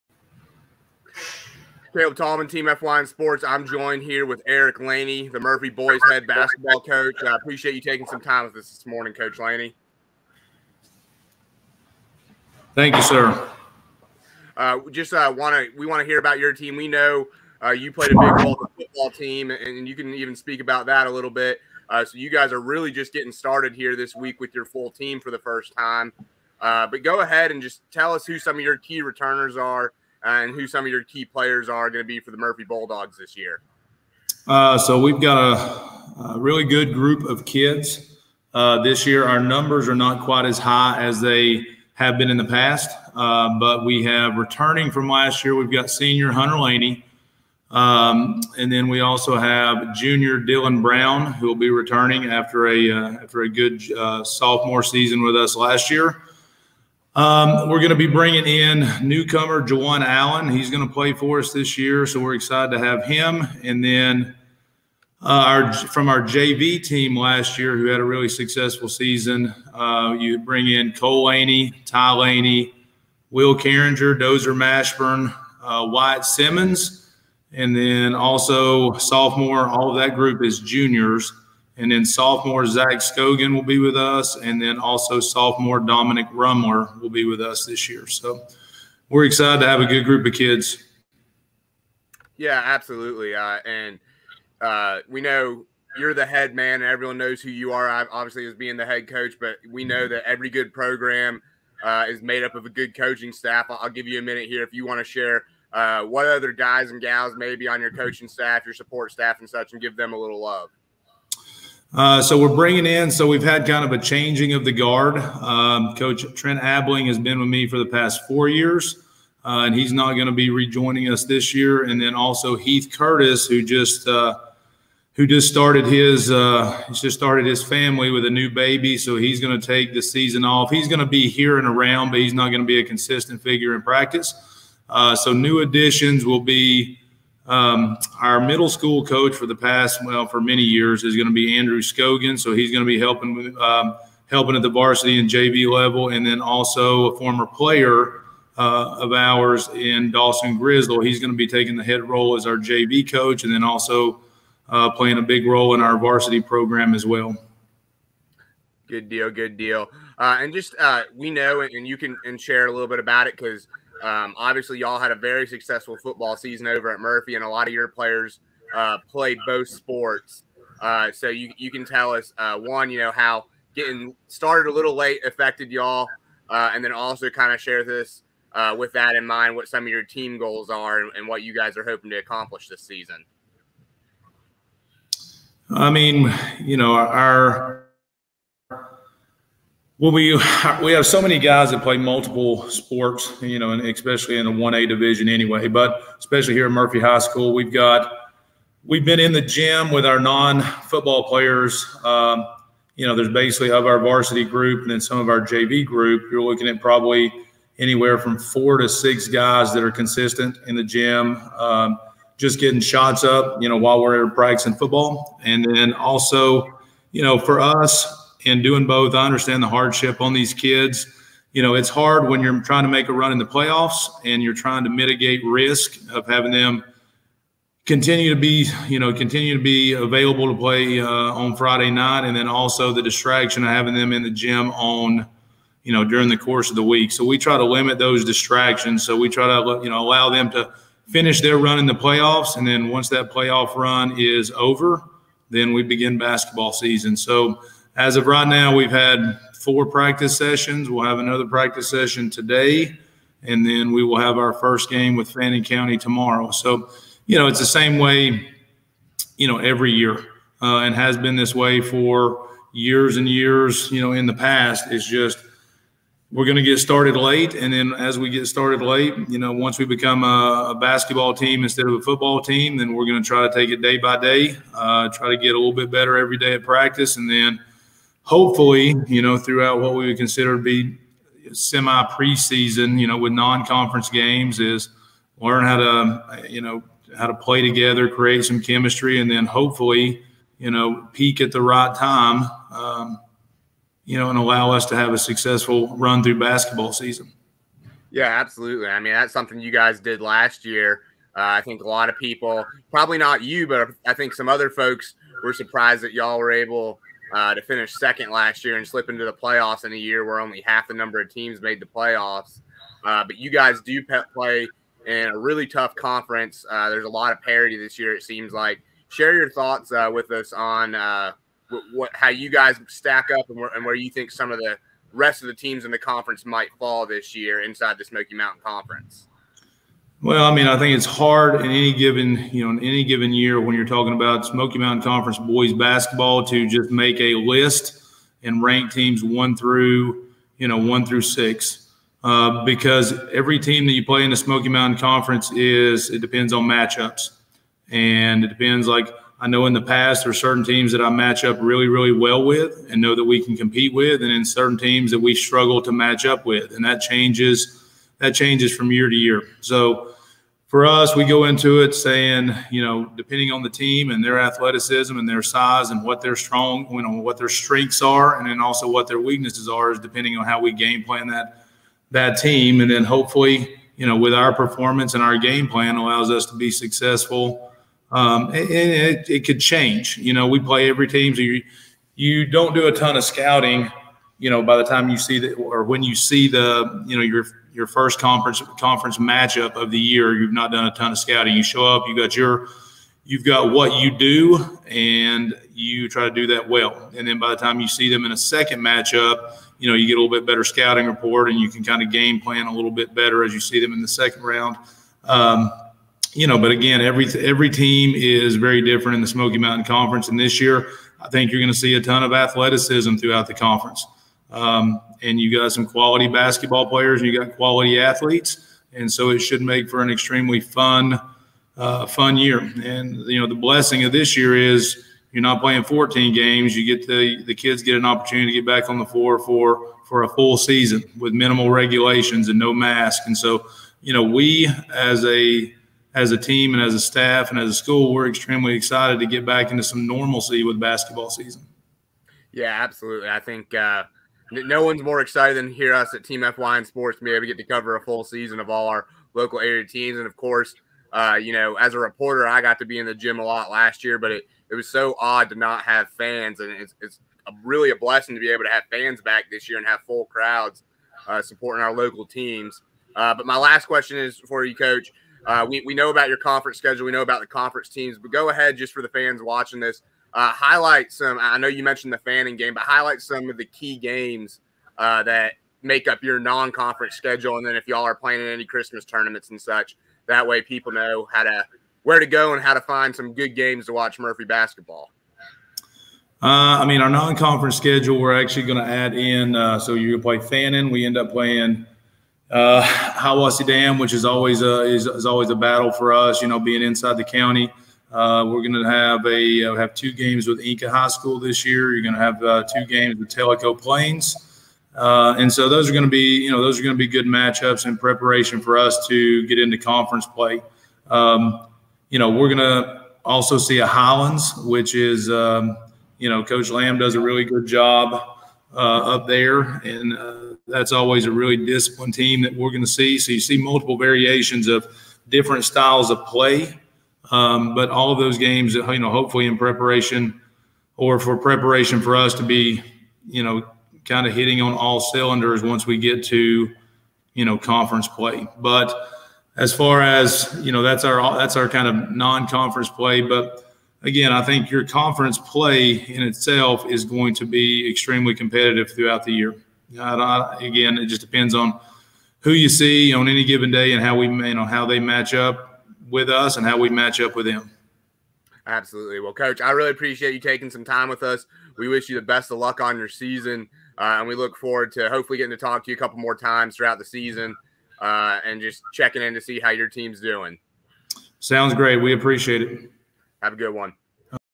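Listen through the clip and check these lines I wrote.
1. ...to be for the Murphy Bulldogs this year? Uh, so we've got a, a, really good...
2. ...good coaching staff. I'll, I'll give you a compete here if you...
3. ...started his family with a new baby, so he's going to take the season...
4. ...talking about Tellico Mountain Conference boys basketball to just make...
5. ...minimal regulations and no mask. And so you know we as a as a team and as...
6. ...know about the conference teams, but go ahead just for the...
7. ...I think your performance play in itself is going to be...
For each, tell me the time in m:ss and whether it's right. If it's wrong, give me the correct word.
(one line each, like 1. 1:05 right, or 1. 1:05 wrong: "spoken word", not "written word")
1. 0:32 right
2. 1:42 wrong: "minute", not "compete"
3. 2:07 right
4. 5:33 wrong: "Smoky", not "Tellico"
5. 7:11 right
6. 7:47 right
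7. 9:04 wrong: "conference", not "performance".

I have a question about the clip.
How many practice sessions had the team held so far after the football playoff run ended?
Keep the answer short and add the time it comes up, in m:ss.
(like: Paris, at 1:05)
4, at 4:09.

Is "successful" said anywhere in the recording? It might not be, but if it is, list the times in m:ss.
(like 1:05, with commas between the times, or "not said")
1:08, 2:45, 4:55, 6:16.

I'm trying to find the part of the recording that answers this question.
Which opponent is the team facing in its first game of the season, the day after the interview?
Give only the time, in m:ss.
4:15.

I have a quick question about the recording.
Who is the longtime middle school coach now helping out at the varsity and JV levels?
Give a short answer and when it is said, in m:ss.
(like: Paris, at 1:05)
Andrew Scogan, at 2:21.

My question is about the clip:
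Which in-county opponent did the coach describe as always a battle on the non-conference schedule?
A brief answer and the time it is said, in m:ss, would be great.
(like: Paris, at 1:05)
Hiwassee Dam, at 8:12.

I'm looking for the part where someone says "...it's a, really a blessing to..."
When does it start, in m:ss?
7:37.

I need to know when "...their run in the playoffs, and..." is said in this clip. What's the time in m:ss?
4:01.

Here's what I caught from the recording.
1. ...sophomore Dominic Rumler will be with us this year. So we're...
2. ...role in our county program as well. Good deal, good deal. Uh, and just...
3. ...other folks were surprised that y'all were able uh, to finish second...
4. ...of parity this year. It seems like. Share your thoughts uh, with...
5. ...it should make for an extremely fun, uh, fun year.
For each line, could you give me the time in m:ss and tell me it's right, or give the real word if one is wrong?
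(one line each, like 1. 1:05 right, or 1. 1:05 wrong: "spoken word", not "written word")
1. 1:25 right
2. 2:35 wrong: "varsity", not "county"
3. 5:04 right
4. 5:17 right
5. 6:59 right.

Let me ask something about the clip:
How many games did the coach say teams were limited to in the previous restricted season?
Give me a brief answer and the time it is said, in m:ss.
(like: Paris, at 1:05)
14, at 7:05.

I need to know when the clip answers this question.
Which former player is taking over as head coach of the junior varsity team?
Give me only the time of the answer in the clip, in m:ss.
2:30.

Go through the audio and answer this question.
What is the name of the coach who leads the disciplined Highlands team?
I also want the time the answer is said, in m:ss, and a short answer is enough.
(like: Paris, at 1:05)
Coach Lamb, at 8:36.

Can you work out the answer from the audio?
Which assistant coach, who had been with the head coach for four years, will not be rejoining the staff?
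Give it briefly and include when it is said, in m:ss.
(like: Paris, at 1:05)
Trent Abling, at 1:56.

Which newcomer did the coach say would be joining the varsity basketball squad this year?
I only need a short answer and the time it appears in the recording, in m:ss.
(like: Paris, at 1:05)
Jawan Allen, at 0:59.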